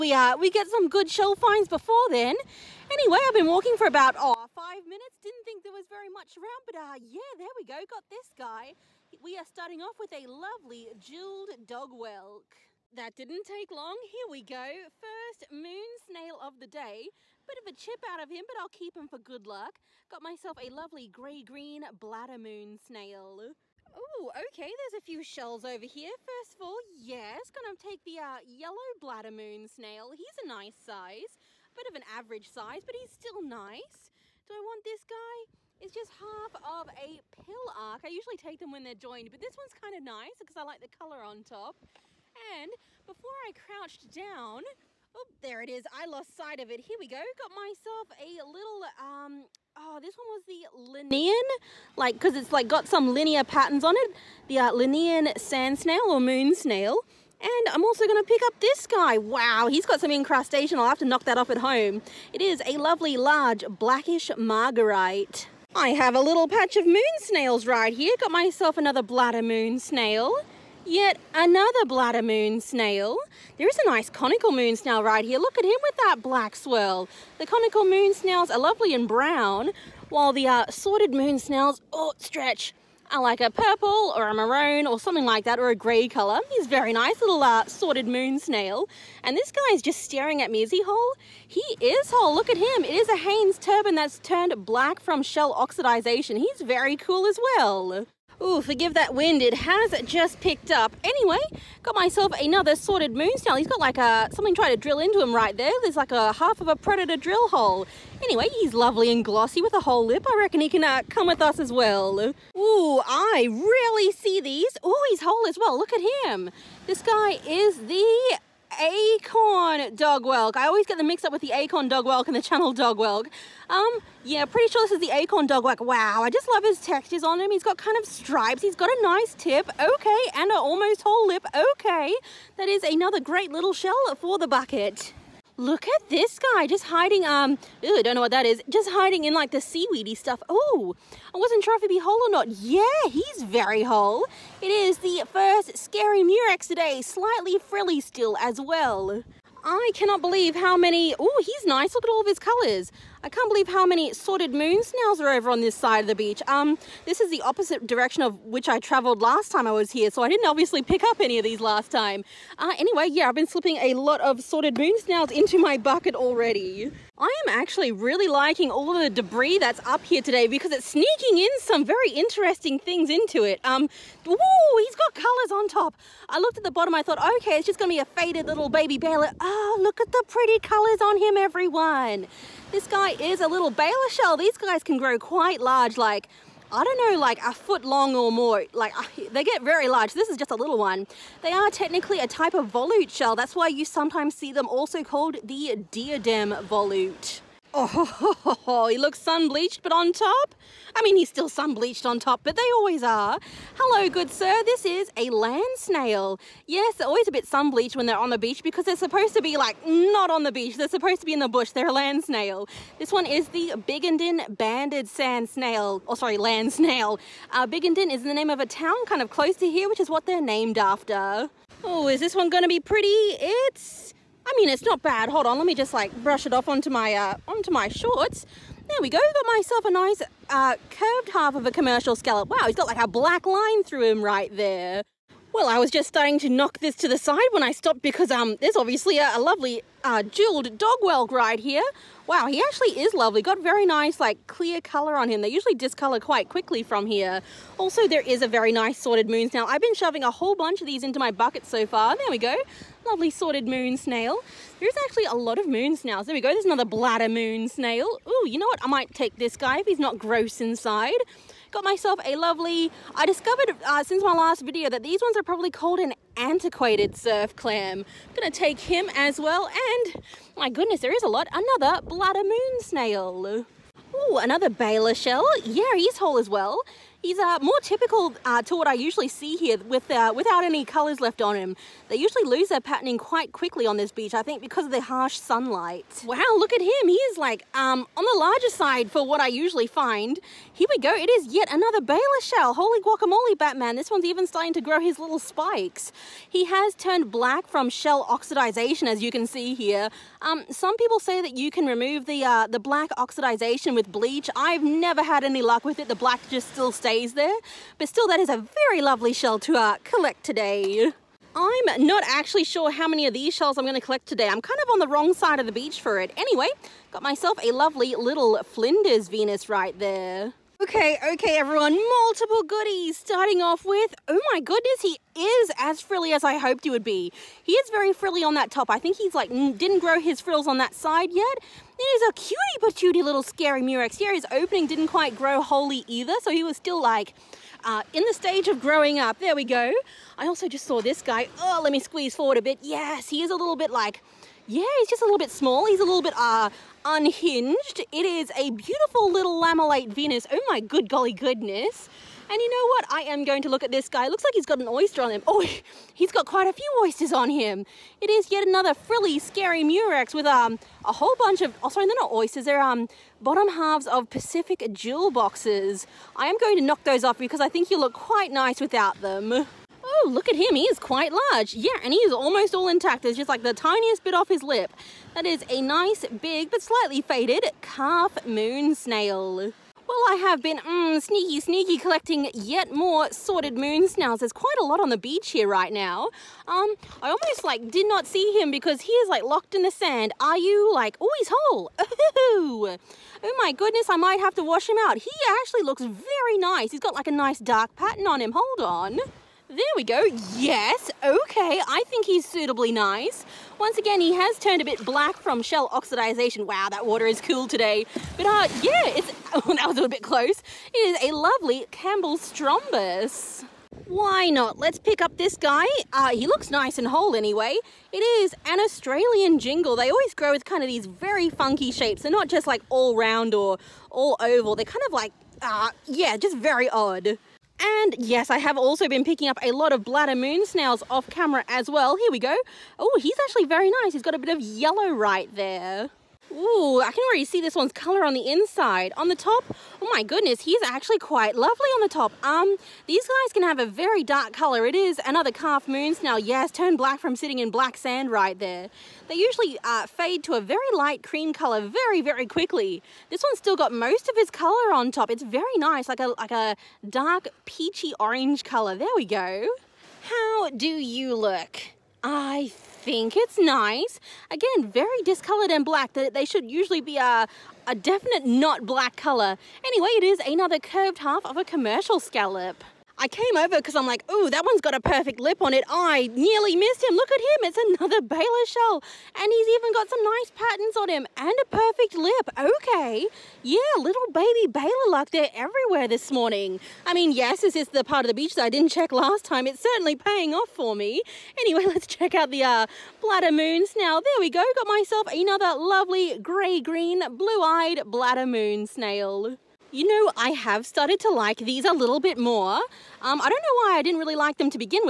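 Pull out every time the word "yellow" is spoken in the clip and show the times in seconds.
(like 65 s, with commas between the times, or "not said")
28 s, 434 s.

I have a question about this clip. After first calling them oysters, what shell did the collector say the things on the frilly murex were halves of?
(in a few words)
Pacific jewel boxes.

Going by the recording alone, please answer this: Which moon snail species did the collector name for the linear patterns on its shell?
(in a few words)
Linnean sand snail.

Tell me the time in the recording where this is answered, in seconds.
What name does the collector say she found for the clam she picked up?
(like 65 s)
266 s.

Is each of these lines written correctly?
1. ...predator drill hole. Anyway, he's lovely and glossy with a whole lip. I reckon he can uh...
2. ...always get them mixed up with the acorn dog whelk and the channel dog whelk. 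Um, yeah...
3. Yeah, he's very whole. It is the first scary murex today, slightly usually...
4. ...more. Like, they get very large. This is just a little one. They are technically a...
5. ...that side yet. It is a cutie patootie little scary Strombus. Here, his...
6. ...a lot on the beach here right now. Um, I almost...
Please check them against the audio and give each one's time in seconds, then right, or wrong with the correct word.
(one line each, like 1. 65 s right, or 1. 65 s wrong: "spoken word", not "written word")
1. 106 s right
2. 120 s right
3. 142 s wrong: "frilly", not "usually"
4. 188 s right
5. 330 s wrong: "Murex", not "Strombus"
6. 384 s right.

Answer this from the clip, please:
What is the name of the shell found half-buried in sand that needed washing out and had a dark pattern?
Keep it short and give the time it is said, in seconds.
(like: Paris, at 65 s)
Campbell Strombus, at 411 s.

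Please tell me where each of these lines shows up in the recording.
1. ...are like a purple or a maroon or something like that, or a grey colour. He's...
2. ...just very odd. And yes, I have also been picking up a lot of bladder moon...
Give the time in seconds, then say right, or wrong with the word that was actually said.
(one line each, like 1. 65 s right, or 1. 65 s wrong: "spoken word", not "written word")
1. 83 s right
2. 426 s right.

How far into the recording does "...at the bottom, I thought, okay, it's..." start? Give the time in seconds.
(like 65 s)
176 s.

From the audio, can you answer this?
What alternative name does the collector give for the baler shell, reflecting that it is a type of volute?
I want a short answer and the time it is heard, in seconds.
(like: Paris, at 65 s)
diadem volute, at 195 s.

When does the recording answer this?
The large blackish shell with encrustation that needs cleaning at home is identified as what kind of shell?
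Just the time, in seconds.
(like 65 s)
64 s.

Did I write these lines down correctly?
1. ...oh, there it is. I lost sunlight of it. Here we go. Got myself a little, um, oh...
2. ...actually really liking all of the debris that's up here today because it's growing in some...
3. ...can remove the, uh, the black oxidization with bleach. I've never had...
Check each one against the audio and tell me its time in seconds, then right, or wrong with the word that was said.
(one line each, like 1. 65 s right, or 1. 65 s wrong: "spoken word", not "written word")
1. 45 s wrong: "sight", not "sunlight"
2. 167 s wrong: "sneaking", not "growing"
3. 301 s right.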